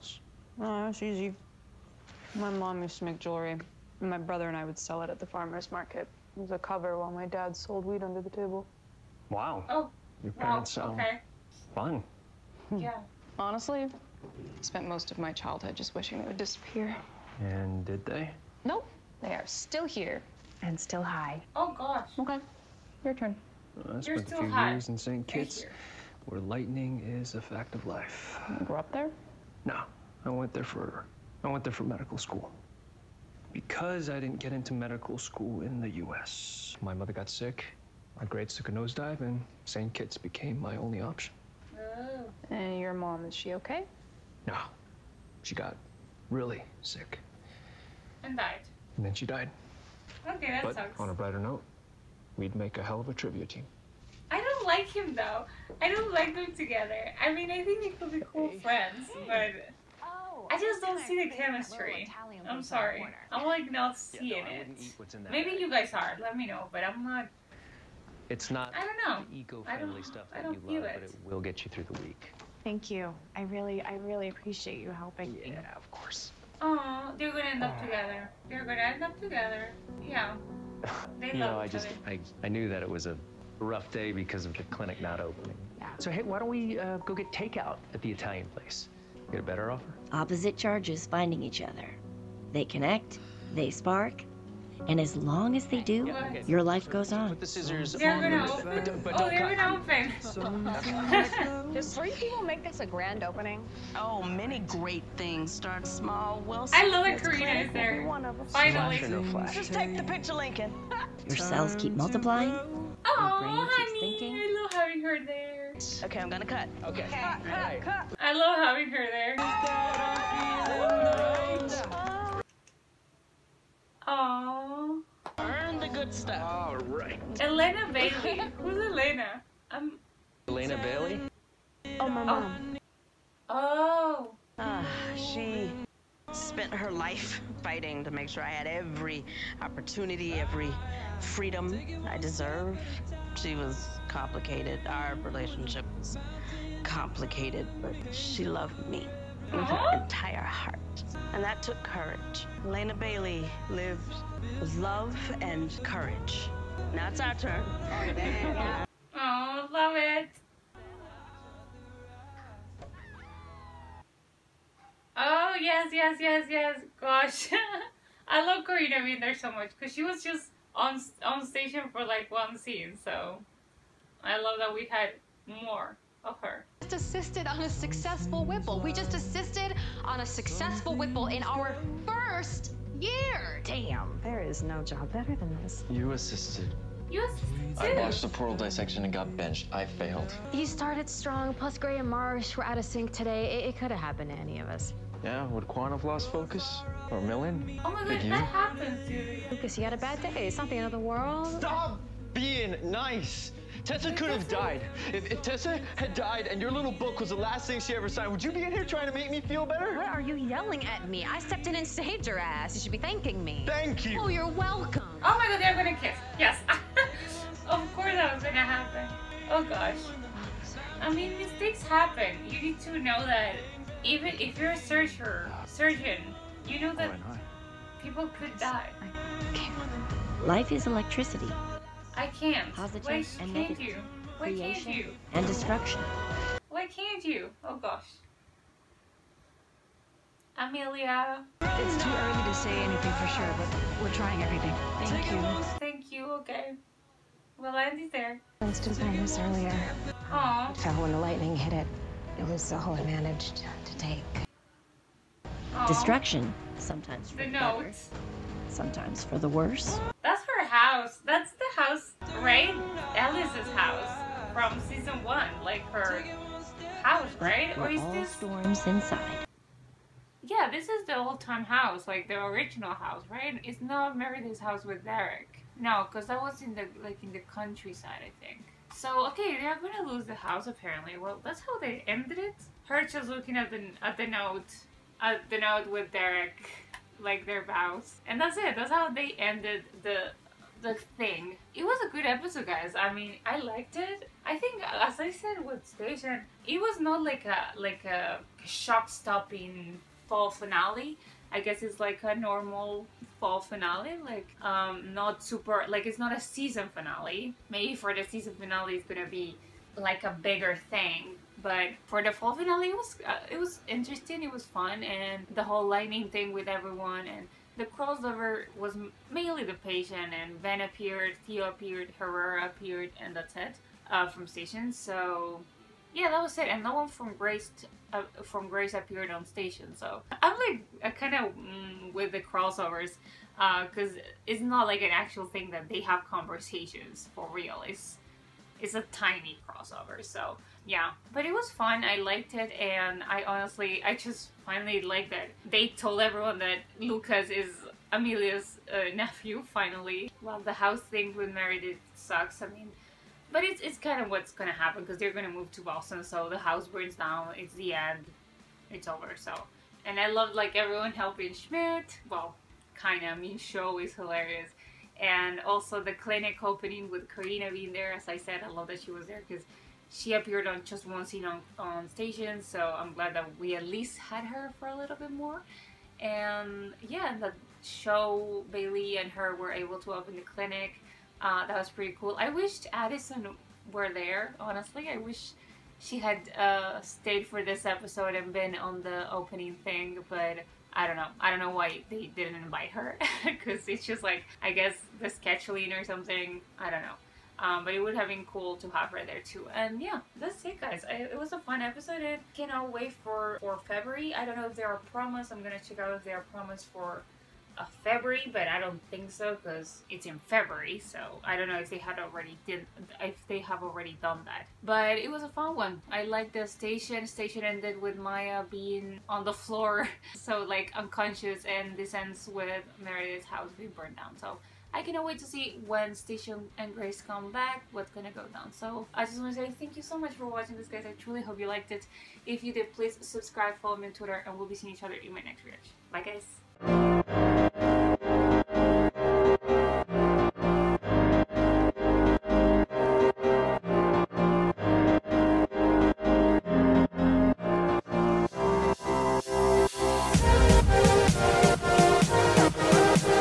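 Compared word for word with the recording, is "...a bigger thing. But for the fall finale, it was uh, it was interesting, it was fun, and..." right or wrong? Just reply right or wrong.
right.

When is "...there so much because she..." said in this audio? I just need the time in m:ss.
2:49.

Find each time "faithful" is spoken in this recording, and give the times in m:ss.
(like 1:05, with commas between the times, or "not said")
not said.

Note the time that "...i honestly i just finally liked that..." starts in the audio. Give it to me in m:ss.
5:43.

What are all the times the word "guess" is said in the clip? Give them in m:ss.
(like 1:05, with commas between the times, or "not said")
5:01, 6:34.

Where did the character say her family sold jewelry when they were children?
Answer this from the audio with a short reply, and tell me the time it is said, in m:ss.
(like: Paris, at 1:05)
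The farmer's market, at 0:05.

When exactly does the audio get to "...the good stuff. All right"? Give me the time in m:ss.
2:05.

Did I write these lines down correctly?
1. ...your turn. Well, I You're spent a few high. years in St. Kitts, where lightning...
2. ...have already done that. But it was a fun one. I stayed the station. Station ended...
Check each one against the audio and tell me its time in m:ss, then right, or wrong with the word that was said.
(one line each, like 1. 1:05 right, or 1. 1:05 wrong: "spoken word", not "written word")
1. 0:23 right
2. 6:53 wrong: "liked", not "stayed".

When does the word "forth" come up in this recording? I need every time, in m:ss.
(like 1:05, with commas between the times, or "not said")
not said.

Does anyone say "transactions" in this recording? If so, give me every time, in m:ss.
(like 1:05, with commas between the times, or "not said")
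not said.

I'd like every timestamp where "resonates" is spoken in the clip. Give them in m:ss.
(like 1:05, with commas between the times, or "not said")
not said.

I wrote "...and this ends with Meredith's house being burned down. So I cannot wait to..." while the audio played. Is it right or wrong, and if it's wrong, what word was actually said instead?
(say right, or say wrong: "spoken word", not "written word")
right.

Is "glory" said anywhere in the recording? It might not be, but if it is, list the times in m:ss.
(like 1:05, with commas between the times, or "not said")
not said.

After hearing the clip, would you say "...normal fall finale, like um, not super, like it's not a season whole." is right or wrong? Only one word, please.
wrong.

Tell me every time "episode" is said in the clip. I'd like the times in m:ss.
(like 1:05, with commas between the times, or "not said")
4:52, 6:27, 6:41.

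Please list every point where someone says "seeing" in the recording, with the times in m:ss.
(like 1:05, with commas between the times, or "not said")
1:03, 7:14.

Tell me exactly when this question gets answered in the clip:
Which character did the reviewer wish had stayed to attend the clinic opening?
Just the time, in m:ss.
6:22.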